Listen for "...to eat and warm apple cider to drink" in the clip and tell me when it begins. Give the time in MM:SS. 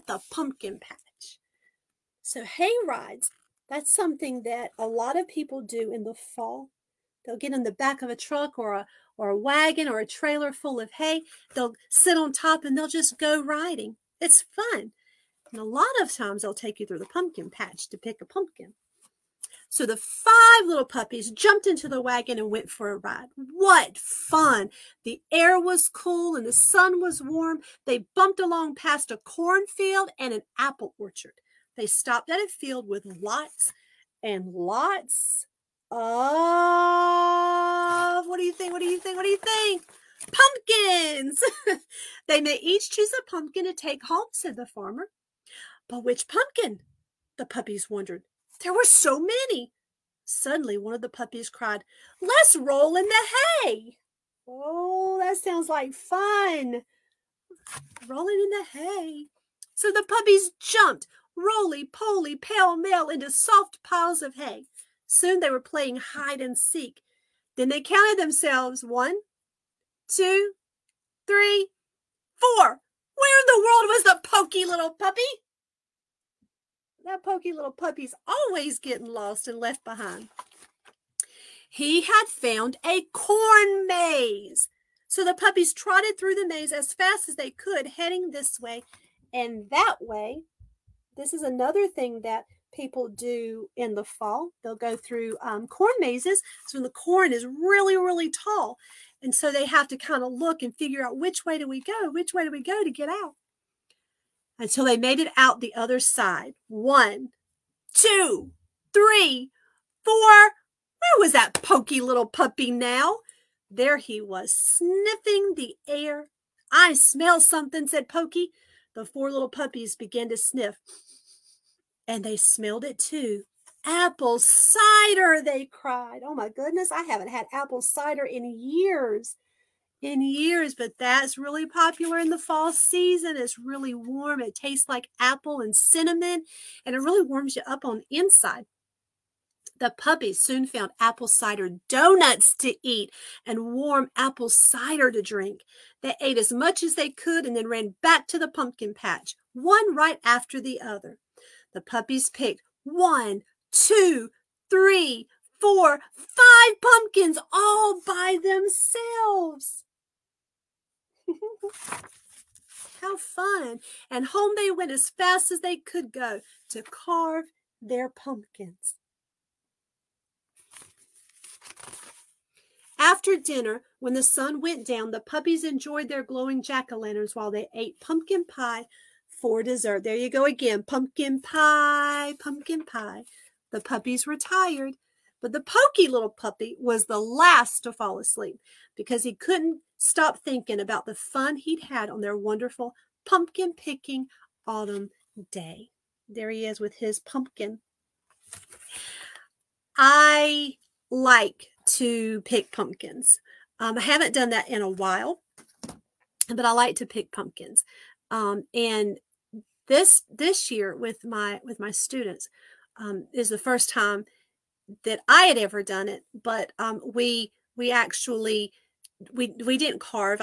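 02:22.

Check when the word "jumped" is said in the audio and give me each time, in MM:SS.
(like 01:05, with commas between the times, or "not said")
00:21, 01:00.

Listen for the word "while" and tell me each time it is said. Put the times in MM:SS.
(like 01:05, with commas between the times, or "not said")
02:57, 03:24.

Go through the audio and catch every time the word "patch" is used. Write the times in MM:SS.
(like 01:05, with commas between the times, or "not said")
00:00, 00:17, 02:28.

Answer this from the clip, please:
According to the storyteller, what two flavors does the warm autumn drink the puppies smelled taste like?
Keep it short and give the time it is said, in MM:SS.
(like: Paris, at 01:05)
apple and cinnamon, at 02:15.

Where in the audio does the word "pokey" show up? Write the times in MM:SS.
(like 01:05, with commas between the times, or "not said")
01:17, 01:51, 01:58.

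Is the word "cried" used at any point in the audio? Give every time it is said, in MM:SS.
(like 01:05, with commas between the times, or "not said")
00:51, 02:05.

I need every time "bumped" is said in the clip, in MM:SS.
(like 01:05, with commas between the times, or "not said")
00:28.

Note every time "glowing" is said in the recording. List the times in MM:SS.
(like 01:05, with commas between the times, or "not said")
02:56.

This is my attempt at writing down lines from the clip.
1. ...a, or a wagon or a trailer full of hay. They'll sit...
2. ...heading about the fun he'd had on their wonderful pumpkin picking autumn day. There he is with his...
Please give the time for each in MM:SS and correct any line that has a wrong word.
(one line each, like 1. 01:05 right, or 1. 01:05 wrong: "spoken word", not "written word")
1. 00:08 right
2. 03:10 wrong: "thinking", not "heading".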